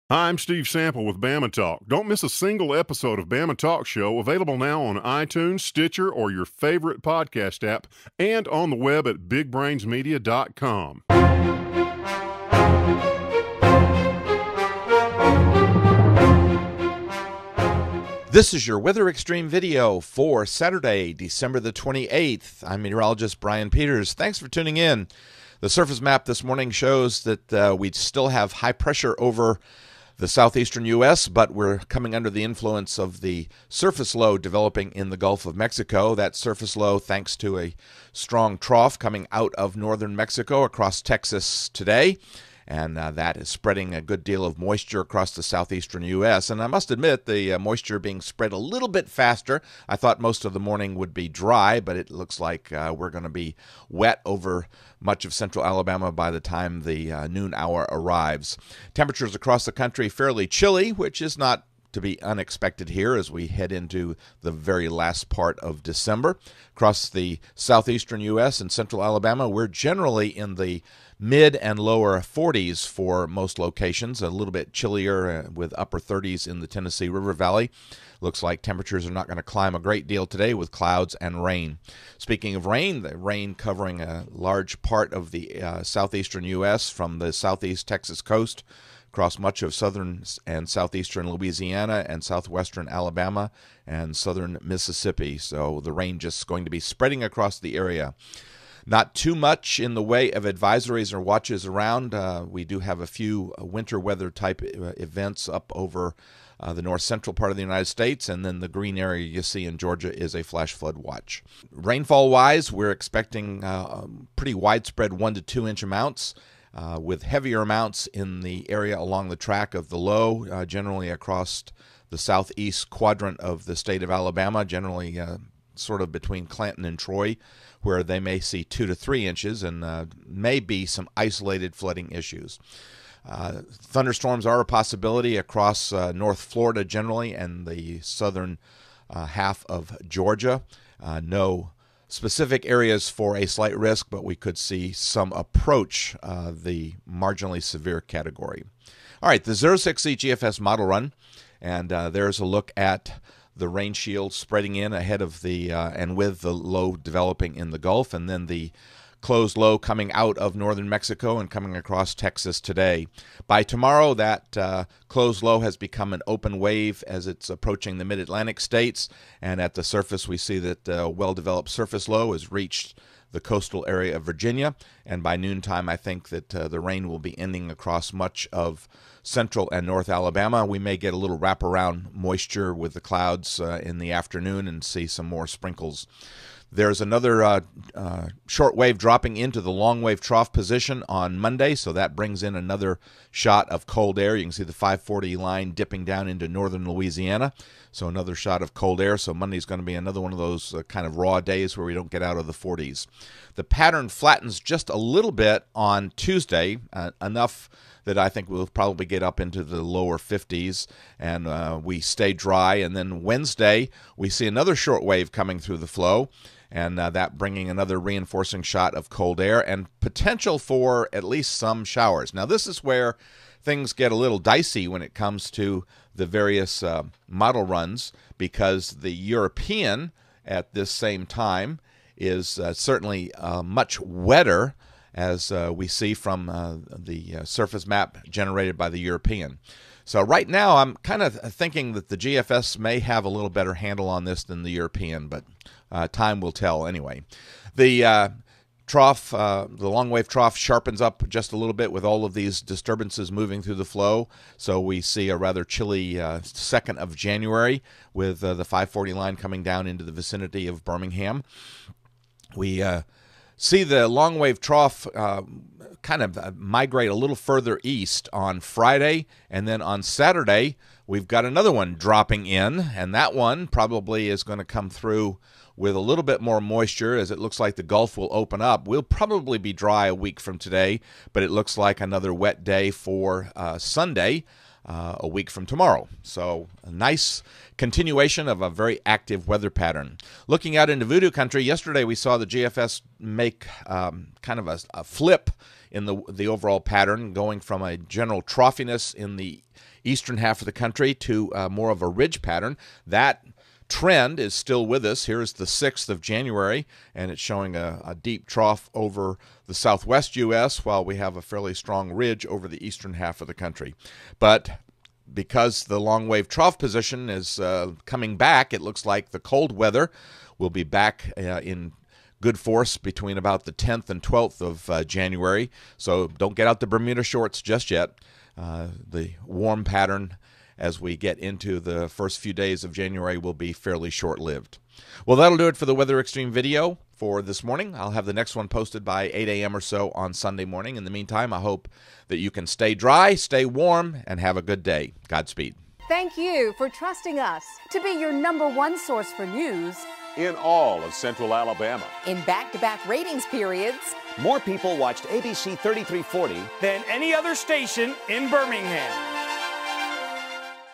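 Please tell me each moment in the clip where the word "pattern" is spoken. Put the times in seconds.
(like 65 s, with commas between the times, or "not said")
203 s, 289 s, 296 s, 302 s, 329 s.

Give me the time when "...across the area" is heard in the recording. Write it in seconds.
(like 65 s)
97 s.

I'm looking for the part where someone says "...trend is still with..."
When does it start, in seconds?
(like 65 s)
303 s.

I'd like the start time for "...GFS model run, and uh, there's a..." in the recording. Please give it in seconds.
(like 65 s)
150 s.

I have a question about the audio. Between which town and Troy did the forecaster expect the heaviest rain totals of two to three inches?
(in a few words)
Clanton.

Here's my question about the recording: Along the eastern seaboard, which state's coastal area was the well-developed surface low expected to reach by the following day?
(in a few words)
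Virginia.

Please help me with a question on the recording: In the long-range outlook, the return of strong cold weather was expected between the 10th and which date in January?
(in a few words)
12th.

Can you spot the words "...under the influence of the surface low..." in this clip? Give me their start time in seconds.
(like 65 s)
32 s.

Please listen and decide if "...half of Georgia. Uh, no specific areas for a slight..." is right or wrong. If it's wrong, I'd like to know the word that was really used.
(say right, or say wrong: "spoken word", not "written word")
right.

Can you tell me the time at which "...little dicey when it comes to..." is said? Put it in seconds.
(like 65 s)
224 s.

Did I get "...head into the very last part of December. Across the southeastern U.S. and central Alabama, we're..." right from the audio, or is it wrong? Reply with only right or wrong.
right.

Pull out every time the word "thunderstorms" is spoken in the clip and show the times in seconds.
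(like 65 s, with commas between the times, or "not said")
133 s.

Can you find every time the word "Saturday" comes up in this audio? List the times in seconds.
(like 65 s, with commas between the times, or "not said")
20 s, 270 s.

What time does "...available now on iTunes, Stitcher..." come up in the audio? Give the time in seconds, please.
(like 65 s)
4 s.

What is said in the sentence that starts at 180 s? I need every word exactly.
We may get a little wraparound moisture with the clouds uh, in the afternoon and see some more sprinkles.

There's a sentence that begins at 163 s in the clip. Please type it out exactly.
By tomorrow, that uh, low has become an open wave as it's approaching the mid Atlantic states.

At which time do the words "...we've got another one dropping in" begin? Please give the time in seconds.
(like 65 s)
271 s.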